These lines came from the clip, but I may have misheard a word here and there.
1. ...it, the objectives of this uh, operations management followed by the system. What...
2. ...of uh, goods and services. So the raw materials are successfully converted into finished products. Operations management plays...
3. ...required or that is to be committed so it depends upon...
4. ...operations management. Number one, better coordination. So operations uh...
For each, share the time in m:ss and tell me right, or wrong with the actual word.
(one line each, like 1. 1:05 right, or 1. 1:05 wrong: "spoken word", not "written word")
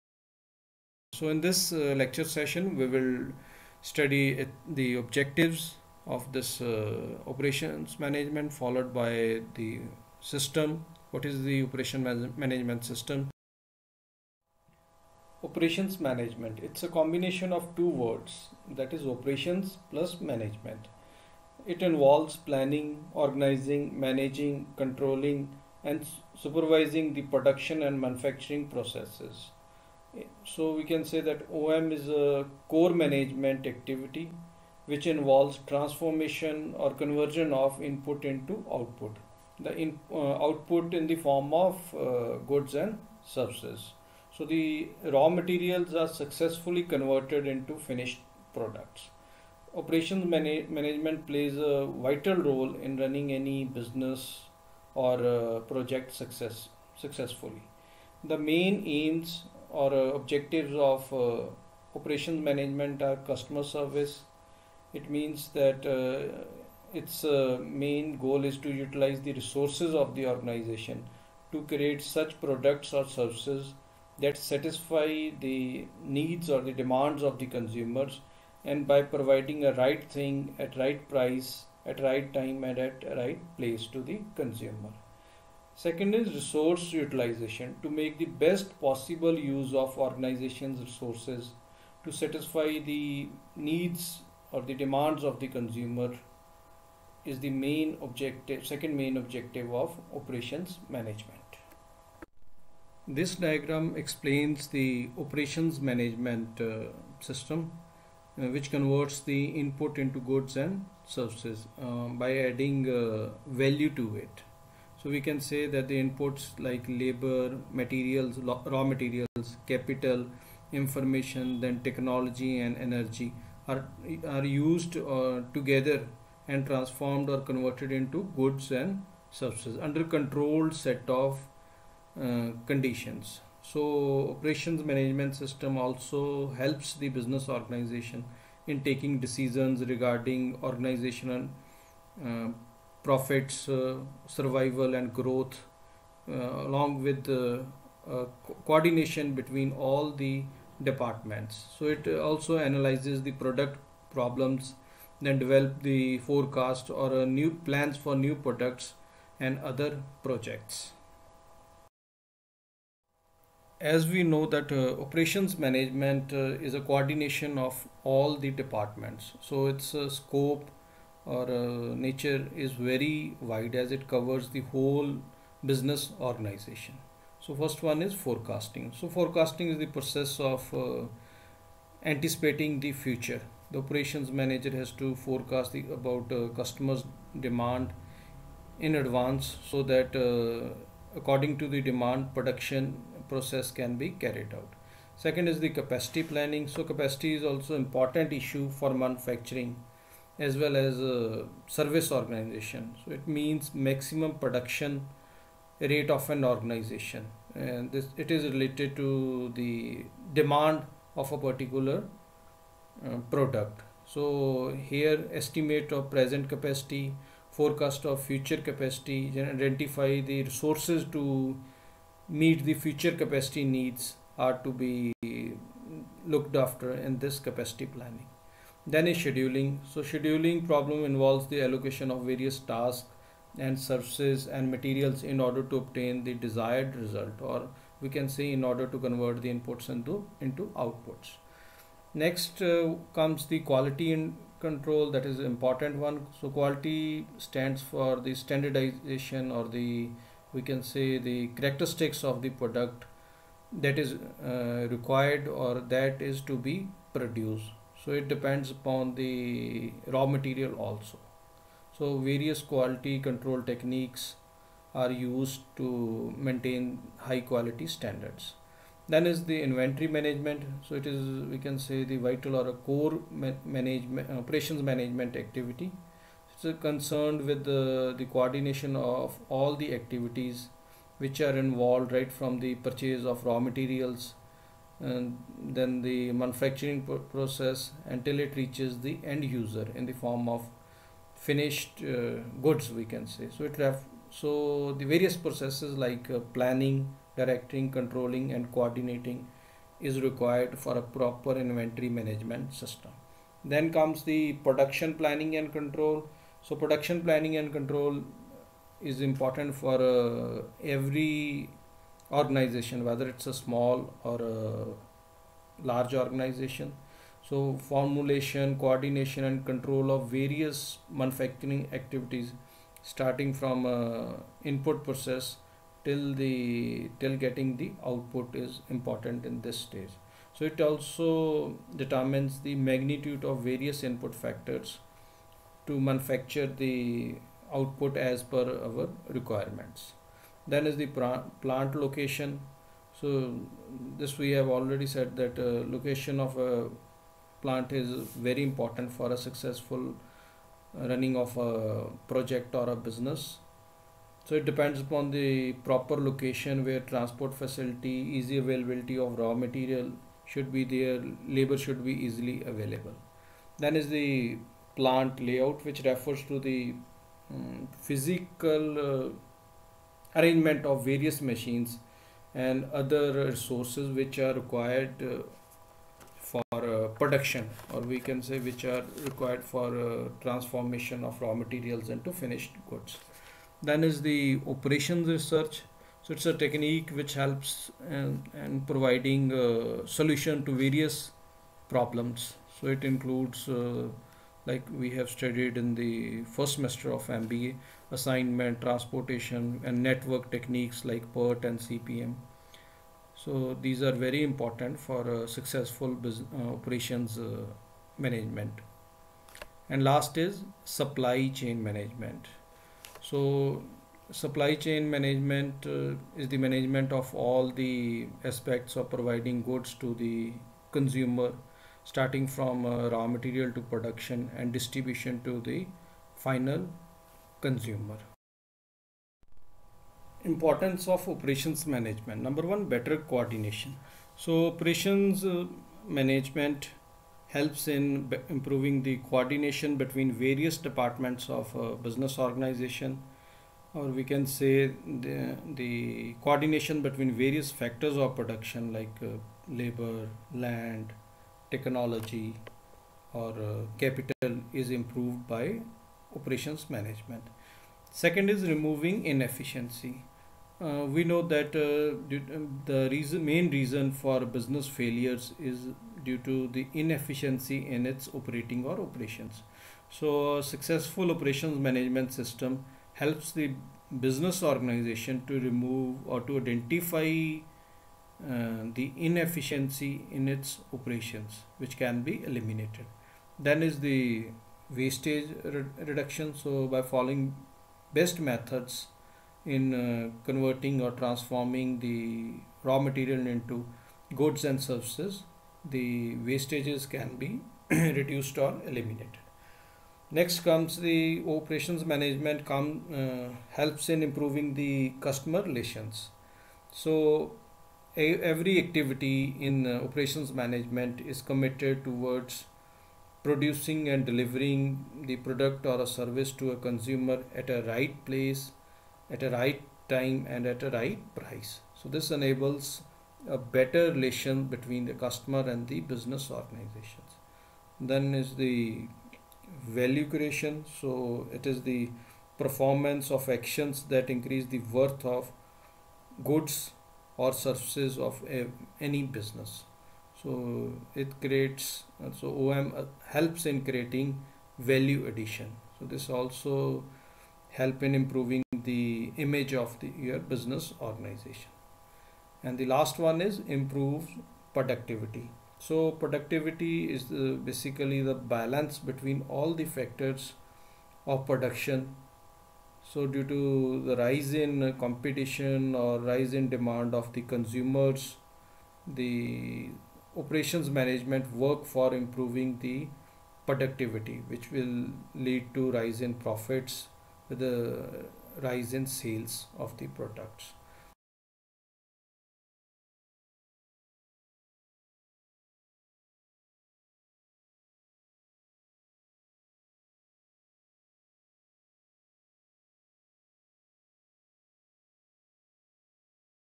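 1. 0:04 right
2. 0:41 right
3. 4:14 wrong: "produced", not "committed"
4. 7:11 right.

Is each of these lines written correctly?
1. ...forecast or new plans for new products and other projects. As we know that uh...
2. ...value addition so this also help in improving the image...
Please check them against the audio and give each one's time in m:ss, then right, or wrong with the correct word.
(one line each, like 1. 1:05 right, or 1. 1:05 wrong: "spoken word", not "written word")
1. 2:36 right
2. 9:04 right.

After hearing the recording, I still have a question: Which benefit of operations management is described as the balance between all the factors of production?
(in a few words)
improve productivity.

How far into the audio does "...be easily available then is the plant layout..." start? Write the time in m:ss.
6:02.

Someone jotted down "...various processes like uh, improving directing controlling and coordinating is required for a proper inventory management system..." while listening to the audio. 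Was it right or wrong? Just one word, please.
wrong.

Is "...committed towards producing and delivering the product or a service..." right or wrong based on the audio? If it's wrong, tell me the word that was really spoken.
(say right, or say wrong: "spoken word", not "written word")
right.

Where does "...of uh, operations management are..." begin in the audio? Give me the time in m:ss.
1:00.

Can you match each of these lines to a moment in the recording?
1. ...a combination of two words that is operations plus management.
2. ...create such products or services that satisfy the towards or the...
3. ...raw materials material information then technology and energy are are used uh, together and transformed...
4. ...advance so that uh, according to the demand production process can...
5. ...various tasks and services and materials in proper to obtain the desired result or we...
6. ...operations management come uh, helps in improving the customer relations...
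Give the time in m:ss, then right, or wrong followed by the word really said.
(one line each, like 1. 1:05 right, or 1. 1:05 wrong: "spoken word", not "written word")
1. 0:16 right
2. 1:11 wrong: "needs", not "towards"
3. 1:58 wrong: "capital", not "material"
4. 3:08 right
5. 3:52 wrong: "order", not "proper"
6. 8:21 right.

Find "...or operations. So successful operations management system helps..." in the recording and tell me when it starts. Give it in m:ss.
7:48.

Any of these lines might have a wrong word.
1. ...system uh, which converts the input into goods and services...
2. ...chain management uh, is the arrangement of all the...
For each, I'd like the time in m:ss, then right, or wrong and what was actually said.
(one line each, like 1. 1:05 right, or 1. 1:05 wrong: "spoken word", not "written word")
1. 1:47 right
2. 6:54 wrong: "management", not "arrangement".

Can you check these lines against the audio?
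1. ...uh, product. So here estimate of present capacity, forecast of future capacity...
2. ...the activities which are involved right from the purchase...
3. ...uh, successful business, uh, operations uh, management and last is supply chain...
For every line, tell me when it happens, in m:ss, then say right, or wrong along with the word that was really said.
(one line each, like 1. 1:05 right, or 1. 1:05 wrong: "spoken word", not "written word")
1. 3:33 right
2. 4:39 right
3. 6:45 right.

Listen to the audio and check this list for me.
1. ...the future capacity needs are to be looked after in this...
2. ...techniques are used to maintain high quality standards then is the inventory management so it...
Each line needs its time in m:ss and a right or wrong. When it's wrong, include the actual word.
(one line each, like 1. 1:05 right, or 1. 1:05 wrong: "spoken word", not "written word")
1. 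3:42 right
2. 4:23 right.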